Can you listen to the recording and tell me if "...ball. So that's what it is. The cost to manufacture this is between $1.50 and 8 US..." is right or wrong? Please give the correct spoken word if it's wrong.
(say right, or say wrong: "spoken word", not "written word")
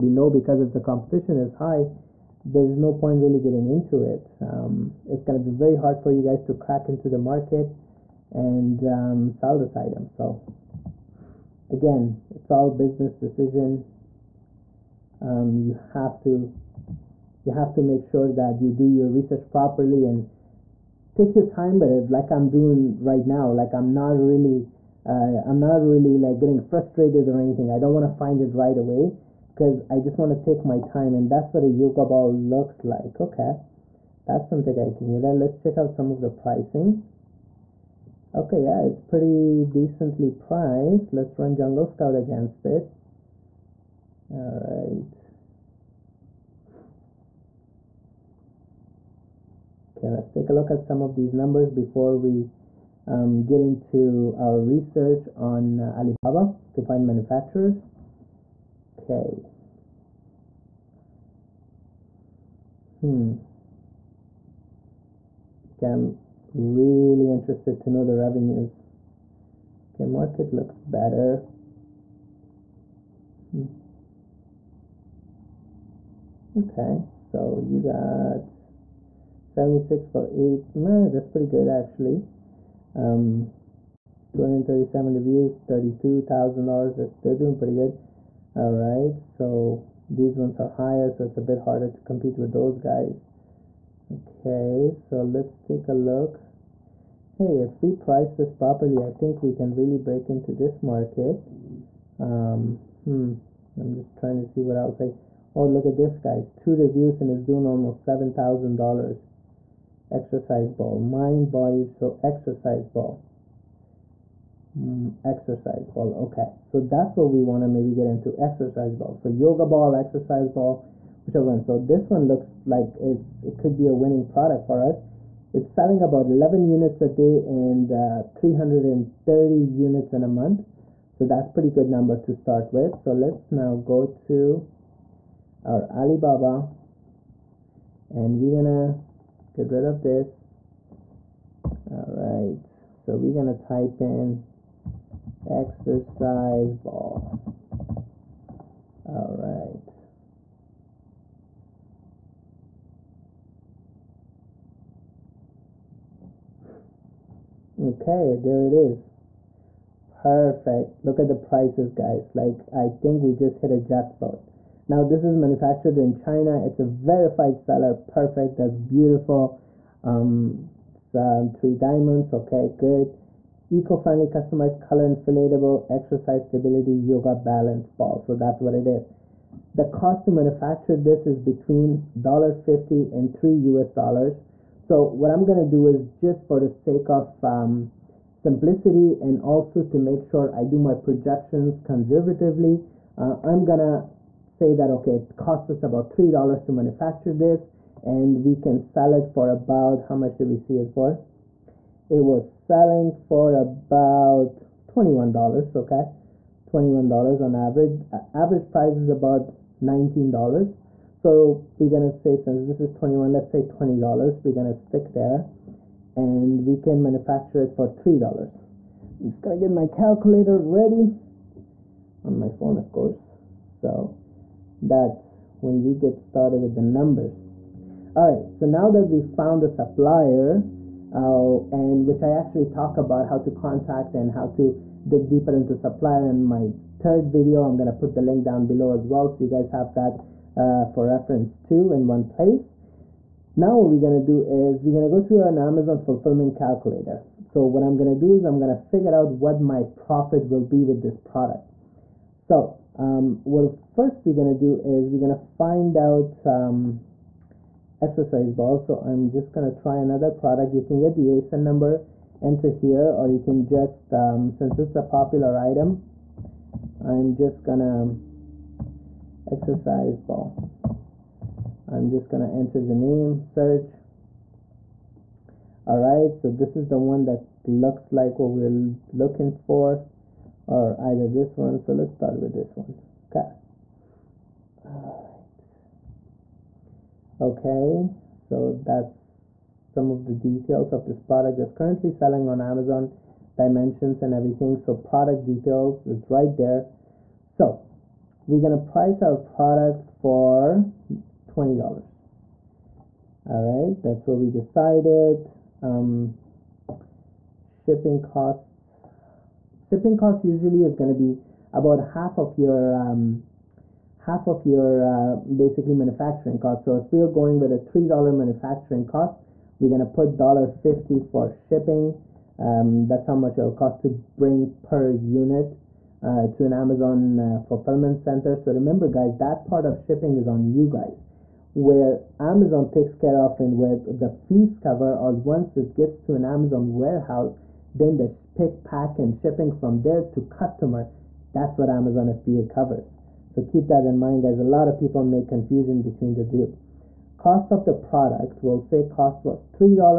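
wrong: "3", not "8".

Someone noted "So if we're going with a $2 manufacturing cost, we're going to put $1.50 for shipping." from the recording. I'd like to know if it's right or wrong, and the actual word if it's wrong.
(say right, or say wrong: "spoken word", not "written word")
wrong: "3", not "2".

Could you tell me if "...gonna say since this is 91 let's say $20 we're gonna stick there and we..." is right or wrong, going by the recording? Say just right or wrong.
wrong.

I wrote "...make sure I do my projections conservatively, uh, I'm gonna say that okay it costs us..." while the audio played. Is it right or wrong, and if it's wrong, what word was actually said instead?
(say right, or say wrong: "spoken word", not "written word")
right.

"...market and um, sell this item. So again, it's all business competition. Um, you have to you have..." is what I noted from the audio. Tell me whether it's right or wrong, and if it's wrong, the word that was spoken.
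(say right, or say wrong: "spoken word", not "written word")
wrong: "decision", not "competition".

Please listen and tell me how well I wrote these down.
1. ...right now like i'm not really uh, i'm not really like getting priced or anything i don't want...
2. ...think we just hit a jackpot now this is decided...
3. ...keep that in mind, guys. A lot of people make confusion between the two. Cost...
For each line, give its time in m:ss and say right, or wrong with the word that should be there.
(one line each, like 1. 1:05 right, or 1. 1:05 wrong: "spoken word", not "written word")
1. 0:23 wrong: "frustrated", not "priced"
2. 2:42 wrong: "manufactured", not "decided"
3. 5:43 right.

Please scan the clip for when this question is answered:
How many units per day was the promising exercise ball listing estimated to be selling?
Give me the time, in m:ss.
2:06.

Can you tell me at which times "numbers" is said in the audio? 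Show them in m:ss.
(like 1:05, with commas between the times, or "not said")
0:51, 2:11, 3:46, 4:21.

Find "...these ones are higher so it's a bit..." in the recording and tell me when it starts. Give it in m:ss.
1:30.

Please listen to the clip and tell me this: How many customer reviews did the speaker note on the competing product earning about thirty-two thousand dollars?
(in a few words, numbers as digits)
237.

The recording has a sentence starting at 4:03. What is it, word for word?
Now what we're gonna do is we're gonna go to an Amazon fulfillment calculator.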